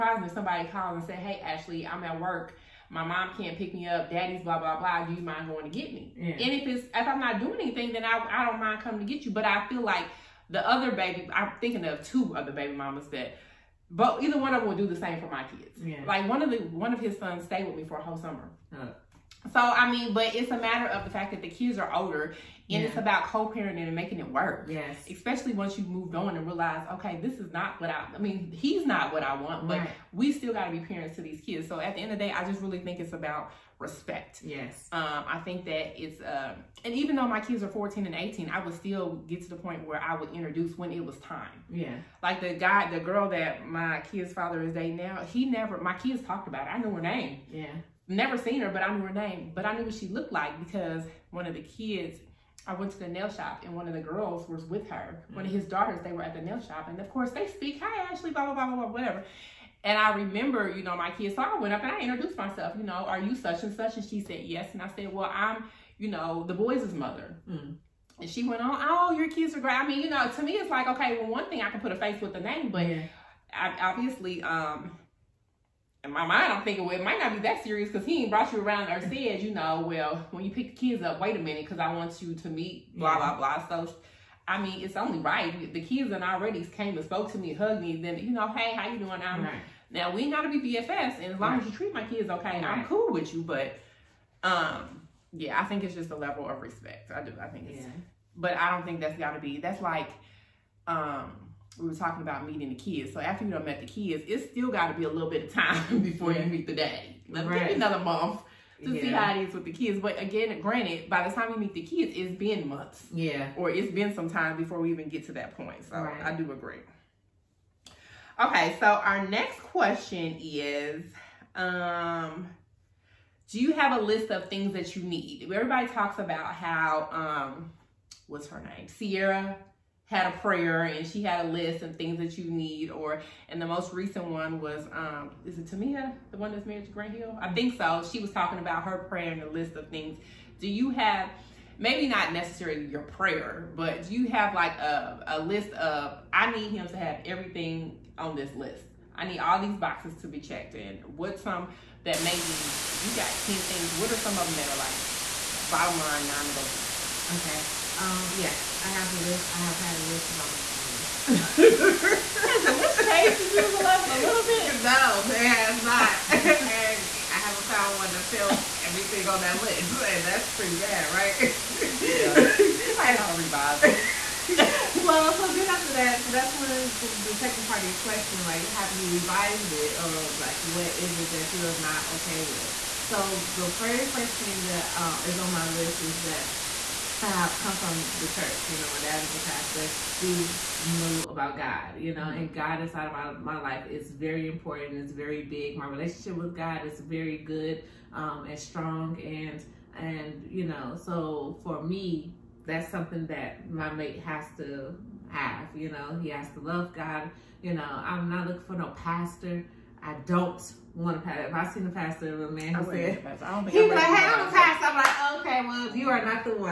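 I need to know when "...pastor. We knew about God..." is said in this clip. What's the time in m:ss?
3:09.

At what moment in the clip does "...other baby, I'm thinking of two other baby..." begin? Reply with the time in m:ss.
0:10.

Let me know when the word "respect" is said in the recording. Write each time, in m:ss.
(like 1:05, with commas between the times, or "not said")
0:33, 1:36.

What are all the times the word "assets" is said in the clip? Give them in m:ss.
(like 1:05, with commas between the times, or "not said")
not said.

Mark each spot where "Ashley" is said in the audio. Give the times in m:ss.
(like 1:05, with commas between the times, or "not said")
0:01, 0:58.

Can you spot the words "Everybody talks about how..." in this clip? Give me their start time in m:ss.
2:05.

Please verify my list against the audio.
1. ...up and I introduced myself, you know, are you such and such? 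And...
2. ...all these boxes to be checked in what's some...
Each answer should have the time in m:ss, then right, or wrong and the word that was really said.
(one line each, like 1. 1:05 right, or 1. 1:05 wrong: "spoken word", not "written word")
1. 1:01 right
2. 2:29 right.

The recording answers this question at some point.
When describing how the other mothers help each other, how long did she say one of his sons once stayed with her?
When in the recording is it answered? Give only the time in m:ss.
0:17.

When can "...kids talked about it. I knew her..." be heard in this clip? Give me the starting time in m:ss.
0:45.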